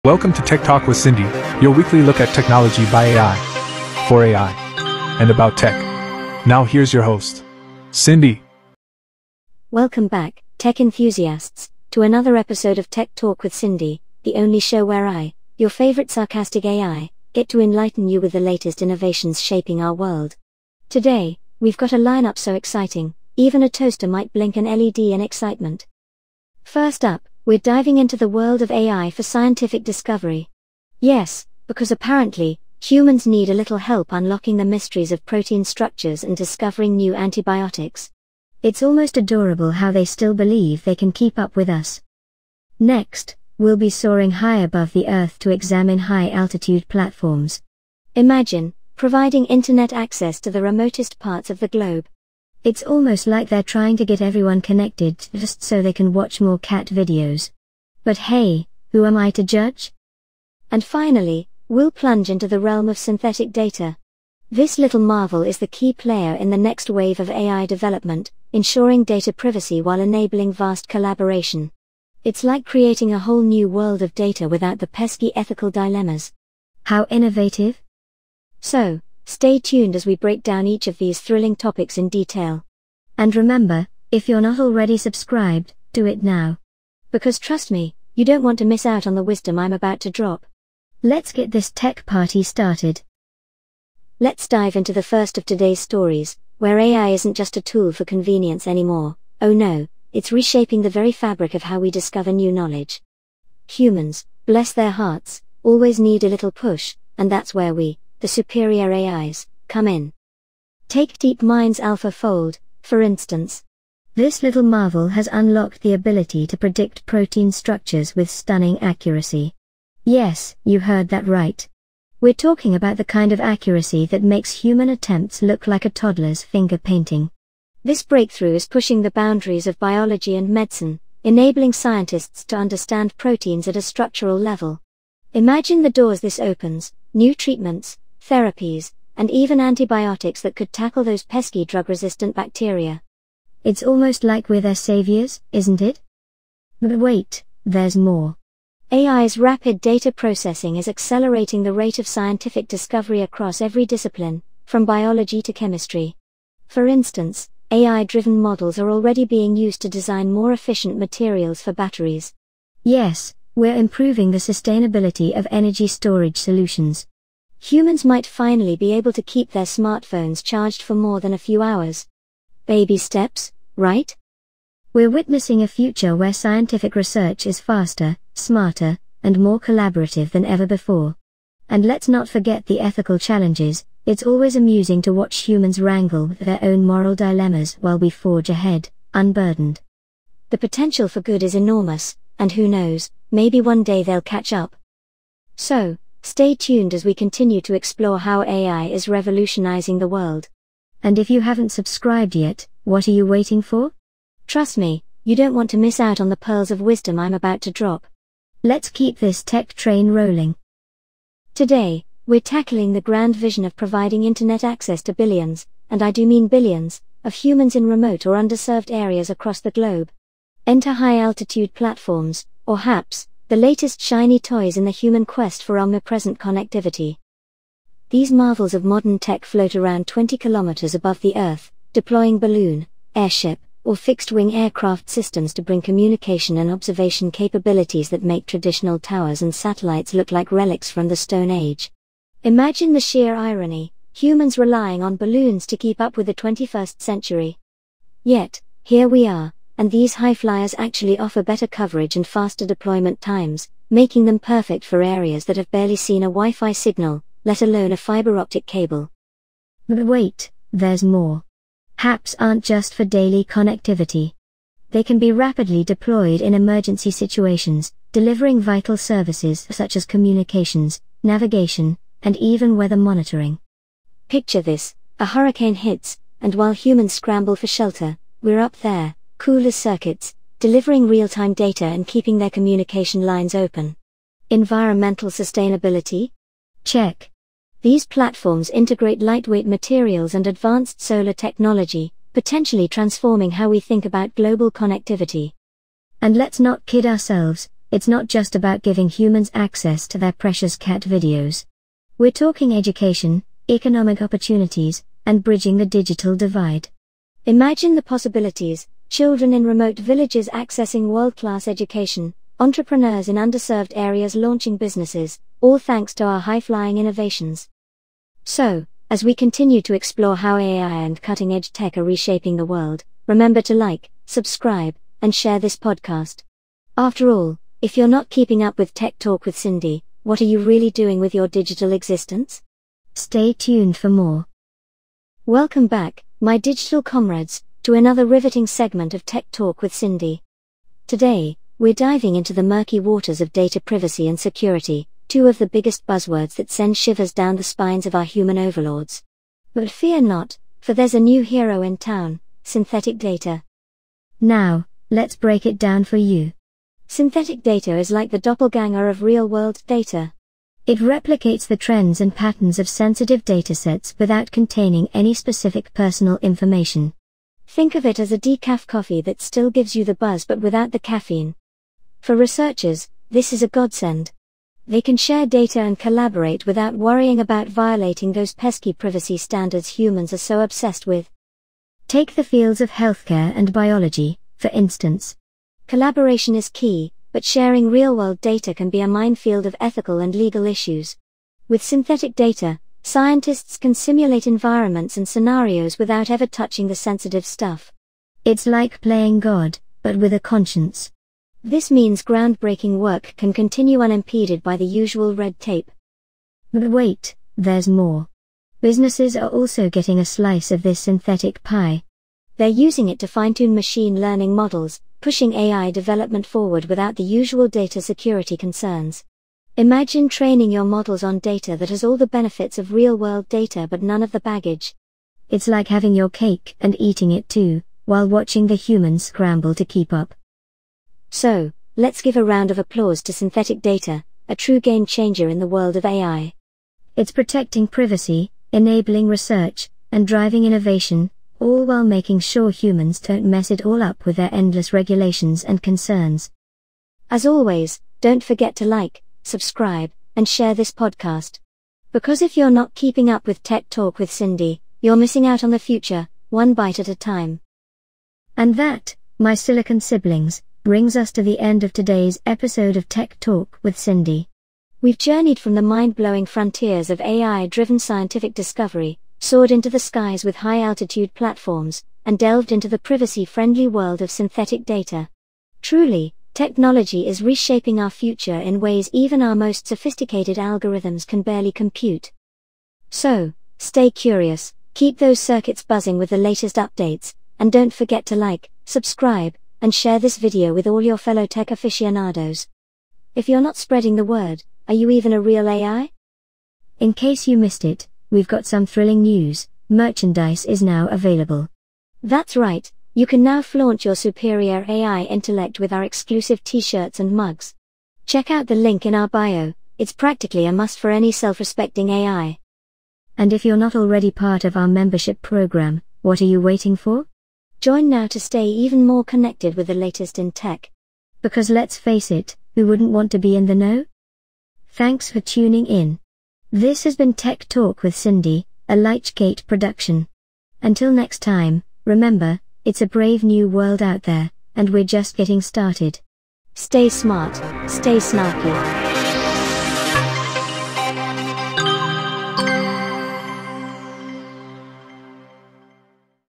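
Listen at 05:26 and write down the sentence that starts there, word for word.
After all, if you're not keeping up with Tech Talk with Cindy, what are you really doing with your digital existence?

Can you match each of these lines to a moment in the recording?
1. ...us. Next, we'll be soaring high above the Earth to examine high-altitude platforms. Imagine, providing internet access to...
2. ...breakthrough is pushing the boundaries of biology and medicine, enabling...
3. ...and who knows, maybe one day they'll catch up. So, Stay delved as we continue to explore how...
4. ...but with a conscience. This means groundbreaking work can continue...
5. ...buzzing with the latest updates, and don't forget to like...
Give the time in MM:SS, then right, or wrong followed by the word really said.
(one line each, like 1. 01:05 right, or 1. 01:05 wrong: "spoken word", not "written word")
1. 00:41 right
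2. 02:08 right
3. 03:12 wrong: "tuned", not "delved"
4. 06:40 right
5. 08:05 right.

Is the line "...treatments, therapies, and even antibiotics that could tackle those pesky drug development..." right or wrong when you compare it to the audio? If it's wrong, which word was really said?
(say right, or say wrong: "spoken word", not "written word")
wrong: "resistant", not "development".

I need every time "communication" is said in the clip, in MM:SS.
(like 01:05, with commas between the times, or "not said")
03:55, 04:30, 04:42.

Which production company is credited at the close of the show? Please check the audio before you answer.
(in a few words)
Lightgate.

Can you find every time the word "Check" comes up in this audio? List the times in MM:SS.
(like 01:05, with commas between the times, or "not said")
04:46, 08:28.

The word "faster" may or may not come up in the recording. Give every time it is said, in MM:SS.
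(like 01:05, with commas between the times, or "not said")
02:57, 04:12.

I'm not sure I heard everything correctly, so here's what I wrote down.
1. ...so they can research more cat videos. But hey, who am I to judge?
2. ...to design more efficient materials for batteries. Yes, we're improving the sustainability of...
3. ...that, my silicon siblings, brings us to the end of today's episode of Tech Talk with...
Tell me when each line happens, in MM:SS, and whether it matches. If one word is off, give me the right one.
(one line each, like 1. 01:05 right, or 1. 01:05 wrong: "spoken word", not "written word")
1. 00:55 wrong: "watch", not "research"
2. 02:39 right
3. 07:38 right.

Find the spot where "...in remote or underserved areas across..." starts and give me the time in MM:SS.
03:37.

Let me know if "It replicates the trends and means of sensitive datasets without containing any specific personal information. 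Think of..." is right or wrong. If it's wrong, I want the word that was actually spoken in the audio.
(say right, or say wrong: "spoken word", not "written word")
wrong: "patterns", not "means".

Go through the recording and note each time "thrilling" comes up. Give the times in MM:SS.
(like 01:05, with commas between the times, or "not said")
01:21, 08:18.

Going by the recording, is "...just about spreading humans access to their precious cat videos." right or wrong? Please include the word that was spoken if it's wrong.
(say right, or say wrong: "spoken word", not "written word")
wrong: "giving", not "spreading".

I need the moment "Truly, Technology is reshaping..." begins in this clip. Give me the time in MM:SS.
07:55.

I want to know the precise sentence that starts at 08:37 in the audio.
Join now to stay even more connected with the latest in tech.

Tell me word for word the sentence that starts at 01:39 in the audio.
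Oh no, it's reshaping the very fabric of how we discover new knowledge.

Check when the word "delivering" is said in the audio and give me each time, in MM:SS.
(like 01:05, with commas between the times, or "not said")
04:28, 04:40.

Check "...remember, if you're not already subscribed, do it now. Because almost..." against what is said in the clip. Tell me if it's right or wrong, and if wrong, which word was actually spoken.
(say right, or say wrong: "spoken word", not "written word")
wrong: "trust", not "almost".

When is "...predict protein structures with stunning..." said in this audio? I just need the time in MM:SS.
01:56.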